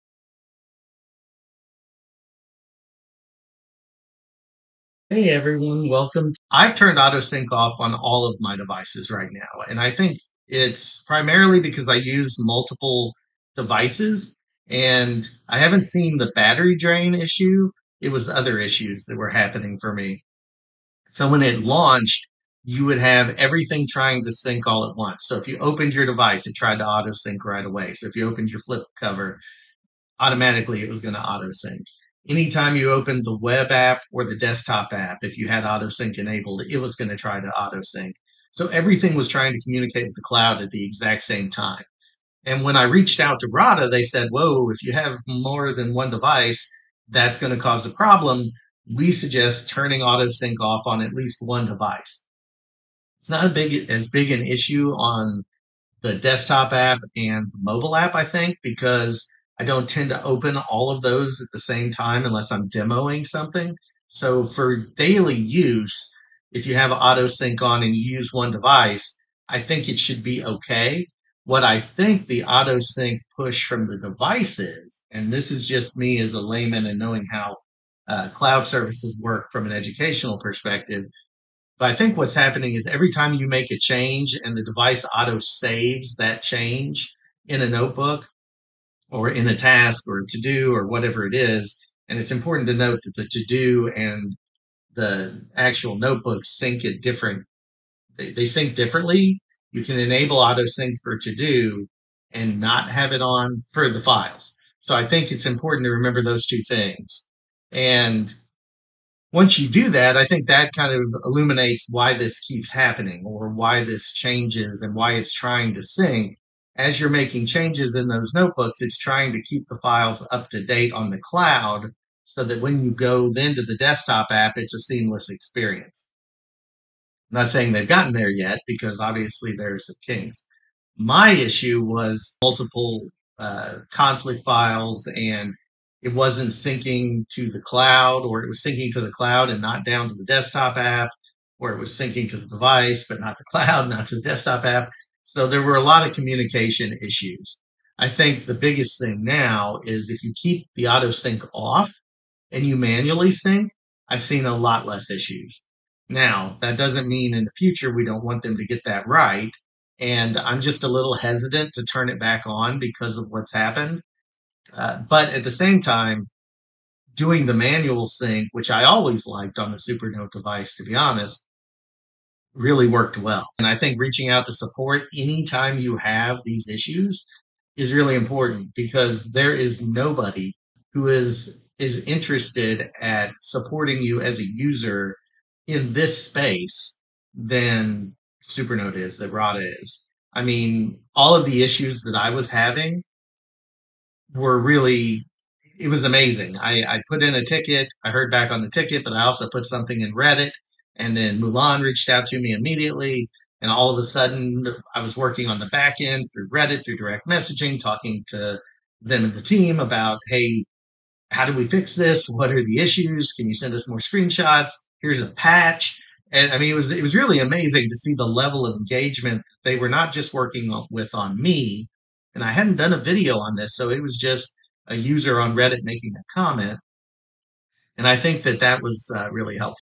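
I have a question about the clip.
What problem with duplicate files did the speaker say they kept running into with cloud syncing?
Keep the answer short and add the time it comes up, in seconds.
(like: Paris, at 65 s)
Conflict files, at 133 s.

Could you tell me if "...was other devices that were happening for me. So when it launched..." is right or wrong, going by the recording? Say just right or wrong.
wrong.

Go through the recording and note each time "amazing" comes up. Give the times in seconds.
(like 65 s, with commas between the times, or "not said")
196 s, 217 s.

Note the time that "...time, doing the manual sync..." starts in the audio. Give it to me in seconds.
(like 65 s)
165 s.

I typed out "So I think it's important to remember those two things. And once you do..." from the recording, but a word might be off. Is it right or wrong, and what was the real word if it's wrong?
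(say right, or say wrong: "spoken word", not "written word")
right.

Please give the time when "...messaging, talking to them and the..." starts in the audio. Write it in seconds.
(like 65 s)
207 s.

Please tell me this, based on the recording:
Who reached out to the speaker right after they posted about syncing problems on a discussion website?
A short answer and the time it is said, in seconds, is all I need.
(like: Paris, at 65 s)
Mulan, at 201 s.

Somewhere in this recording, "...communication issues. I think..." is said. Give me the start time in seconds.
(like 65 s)
146 s.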